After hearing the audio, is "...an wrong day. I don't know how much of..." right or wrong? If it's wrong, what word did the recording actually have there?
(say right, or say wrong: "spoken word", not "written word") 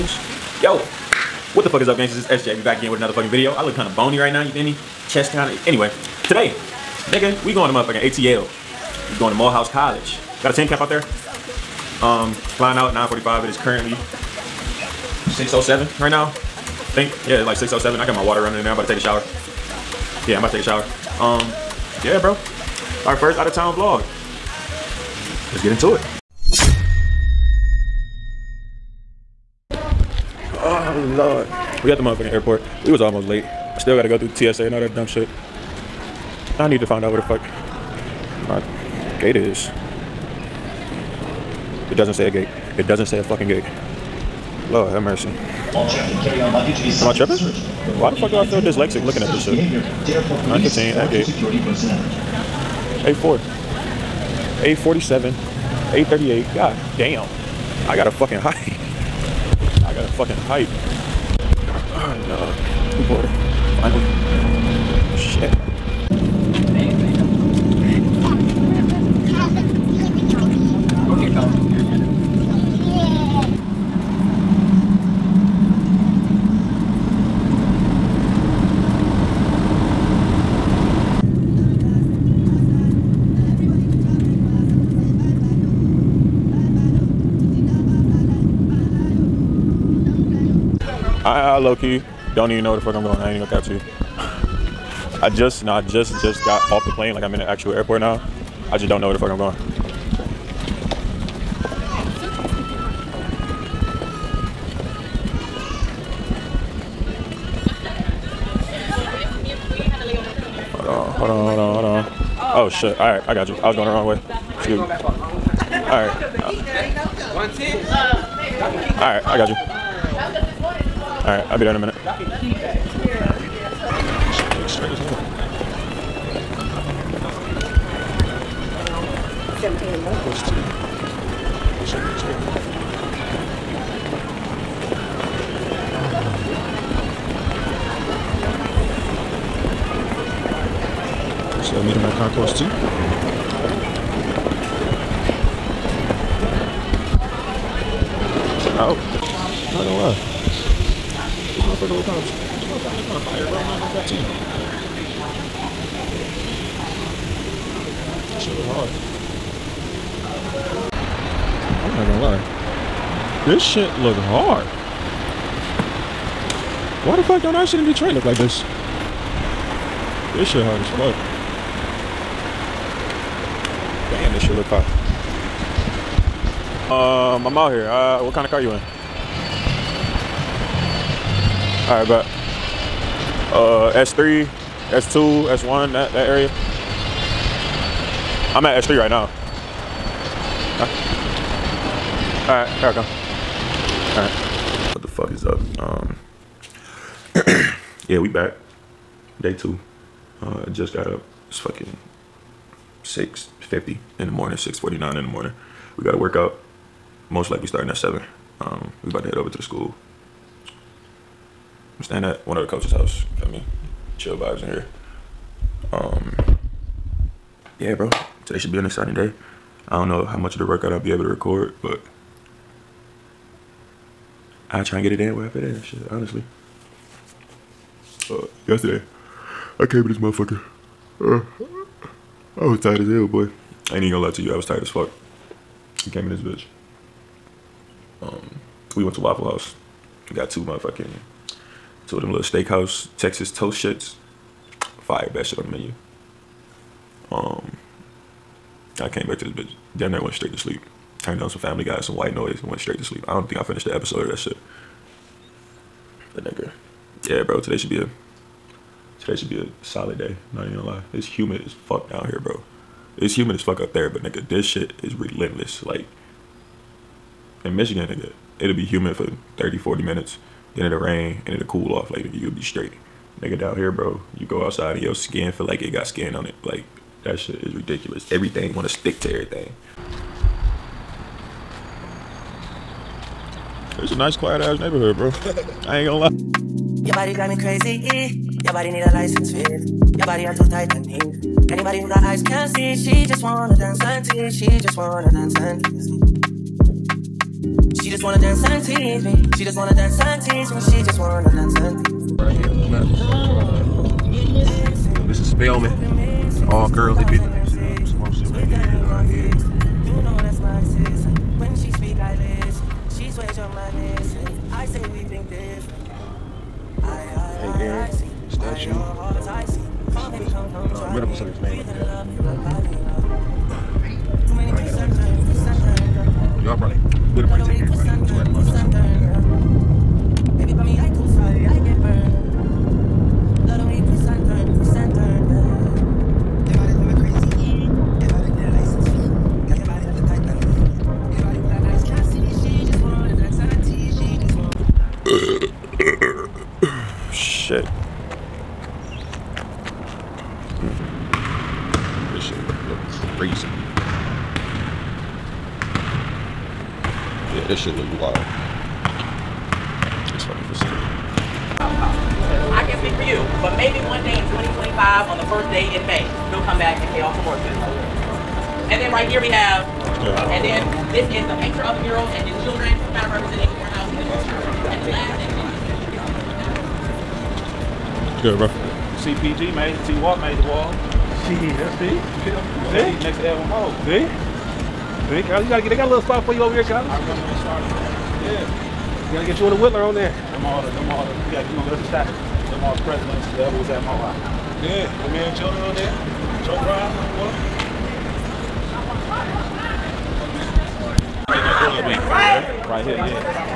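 wrong: "exciting", not "wrong".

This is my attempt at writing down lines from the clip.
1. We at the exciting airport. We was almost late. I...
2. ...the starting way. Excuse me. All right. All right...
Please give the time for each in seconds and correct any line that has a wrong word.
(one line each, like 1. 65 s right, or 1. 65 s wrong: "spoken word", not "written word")
1. 31 s wrong: "motherfucking", not "exciting"
2. 113 s wrong: "wrong", not "starting".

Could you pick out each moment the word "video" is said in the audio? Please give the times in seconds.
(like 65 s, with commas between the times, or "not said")
3 s.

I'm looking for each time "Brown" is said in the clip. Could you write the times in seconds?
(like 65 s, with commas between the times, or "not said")
396 s.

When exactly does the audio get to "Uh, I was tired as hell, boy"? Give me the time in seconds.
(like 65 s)
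231 s.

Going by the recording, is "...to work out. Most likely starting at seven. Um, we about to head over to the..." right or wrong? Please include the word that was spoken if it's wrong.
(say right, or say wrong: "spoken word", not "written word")
right.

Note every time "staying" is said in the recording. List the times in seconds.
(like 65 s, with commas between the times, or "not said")
212 s.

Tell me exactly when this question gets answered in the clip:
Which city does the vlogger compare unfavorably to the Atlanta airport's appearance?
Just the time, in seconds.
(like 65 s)
167 s.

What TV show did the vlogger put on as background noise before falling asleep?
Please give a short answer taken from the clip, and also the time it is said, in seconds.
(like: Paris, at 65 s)
Family Guy, at 251 s.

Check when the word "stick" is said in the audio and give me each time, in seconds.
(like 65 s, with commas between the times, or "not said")
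278 s.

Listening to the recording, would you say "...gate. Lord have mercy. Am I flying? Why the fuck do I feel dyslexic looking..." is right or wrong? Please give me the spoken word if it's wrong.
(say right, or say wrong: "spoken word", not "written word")
wrong: "tripping", not "flying".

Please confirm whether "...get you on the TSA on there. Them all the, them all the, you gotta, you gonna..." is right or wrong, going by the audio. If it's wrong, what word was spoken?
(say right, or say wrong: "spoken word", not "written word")
wrong: "Whitler", not "TSA".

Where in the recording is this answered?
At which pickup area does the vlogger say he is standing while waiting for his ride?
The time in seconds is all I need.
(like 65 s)
188 s.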